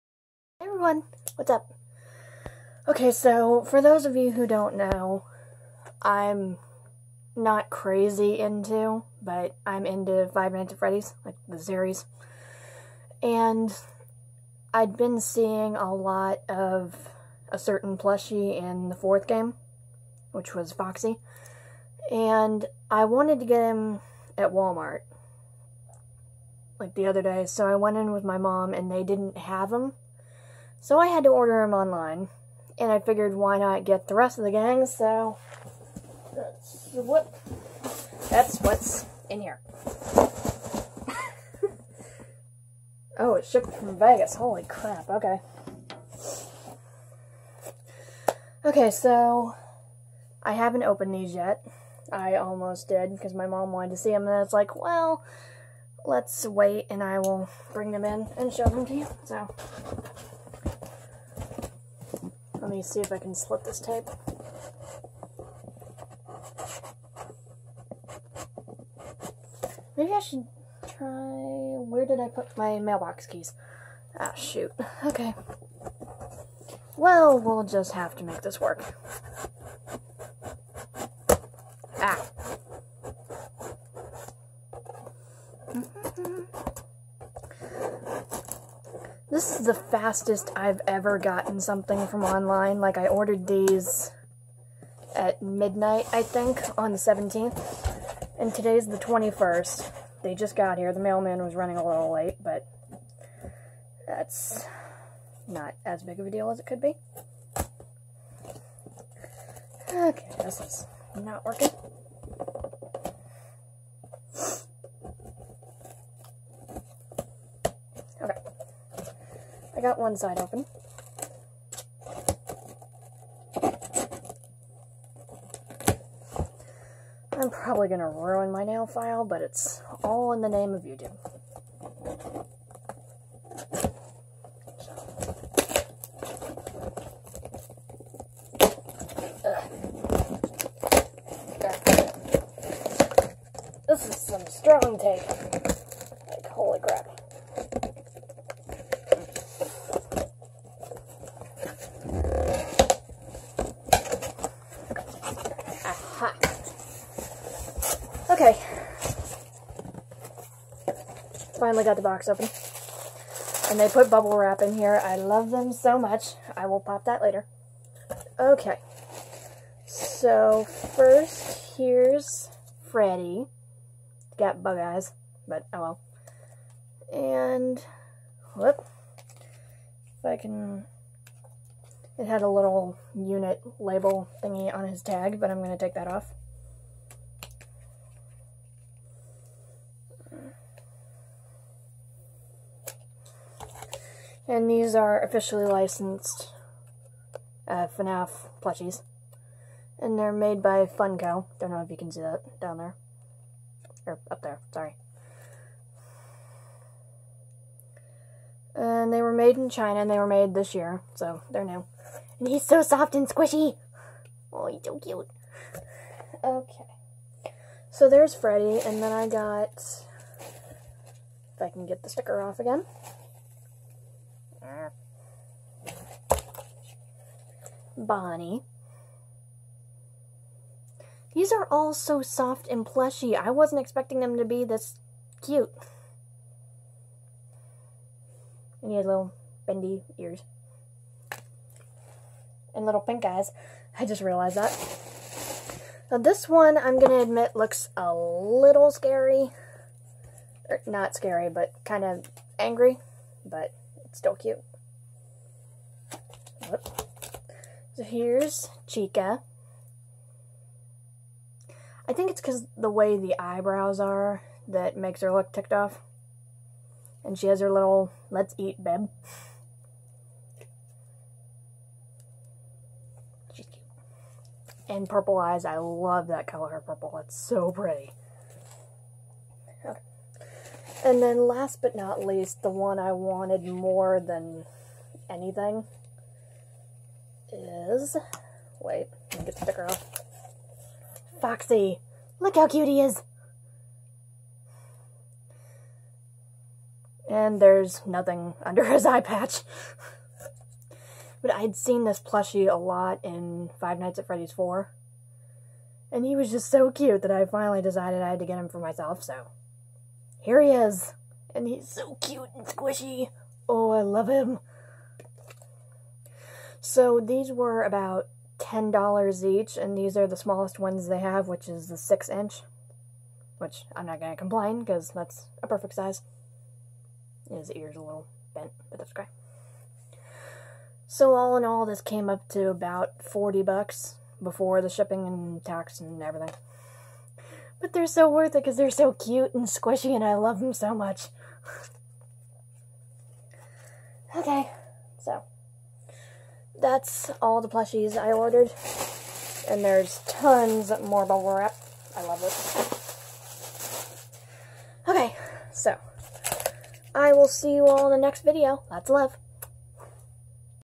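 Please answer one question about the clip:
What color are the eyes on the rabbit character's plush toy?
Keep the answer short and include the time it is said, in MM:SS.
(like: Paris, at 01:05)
Pink, at 04:03.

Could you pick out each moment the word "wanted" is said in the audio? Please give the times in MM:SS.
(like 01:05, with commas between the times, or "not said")
00:23, 00:53, 04:43.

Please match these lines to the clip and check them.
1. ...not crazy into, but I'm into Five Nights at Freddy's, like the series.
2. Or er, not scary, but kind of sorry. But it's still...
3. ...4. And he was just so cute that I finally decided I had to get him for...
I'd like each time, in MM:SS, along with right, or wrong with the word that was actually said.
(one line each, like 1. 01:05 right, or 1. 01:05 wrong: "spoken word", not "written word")
1. 00:07 right
2. 04:10 wrong: "angry", not "sorry"
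3. 05:04 right.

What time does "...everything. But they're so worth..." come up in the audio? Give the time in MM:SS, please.
05:36.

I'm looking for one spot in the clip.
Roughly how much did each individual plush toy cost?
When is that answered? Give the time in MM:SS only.
05:18.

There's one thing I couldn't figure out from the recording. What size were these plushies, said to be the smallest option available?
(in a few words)
6 inch.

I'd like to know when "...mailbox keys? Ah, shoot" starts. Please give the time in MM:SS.
01:12.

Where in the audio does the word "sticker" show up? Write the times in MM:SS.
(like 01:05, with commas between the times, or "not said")
03:42, 04:49.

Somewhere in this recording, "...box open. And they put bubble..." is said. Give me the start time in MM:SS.
02:42.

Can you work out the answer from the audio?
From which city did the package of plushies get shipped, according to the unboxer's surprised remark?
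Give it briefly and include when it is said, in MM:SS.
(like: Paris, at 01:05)
Vegas, at 00:43.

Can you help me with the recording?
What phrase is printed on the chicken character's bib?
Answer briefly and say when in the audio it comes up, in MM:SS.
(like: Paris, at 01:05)
Let's eat, at 04:28.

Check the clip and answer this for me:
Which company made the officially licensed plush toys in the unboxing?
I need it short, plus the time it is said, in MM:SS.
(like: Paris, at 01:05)
Funko, at 03:20.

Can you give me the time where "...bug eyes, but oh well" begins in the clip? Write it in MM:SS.
02:54.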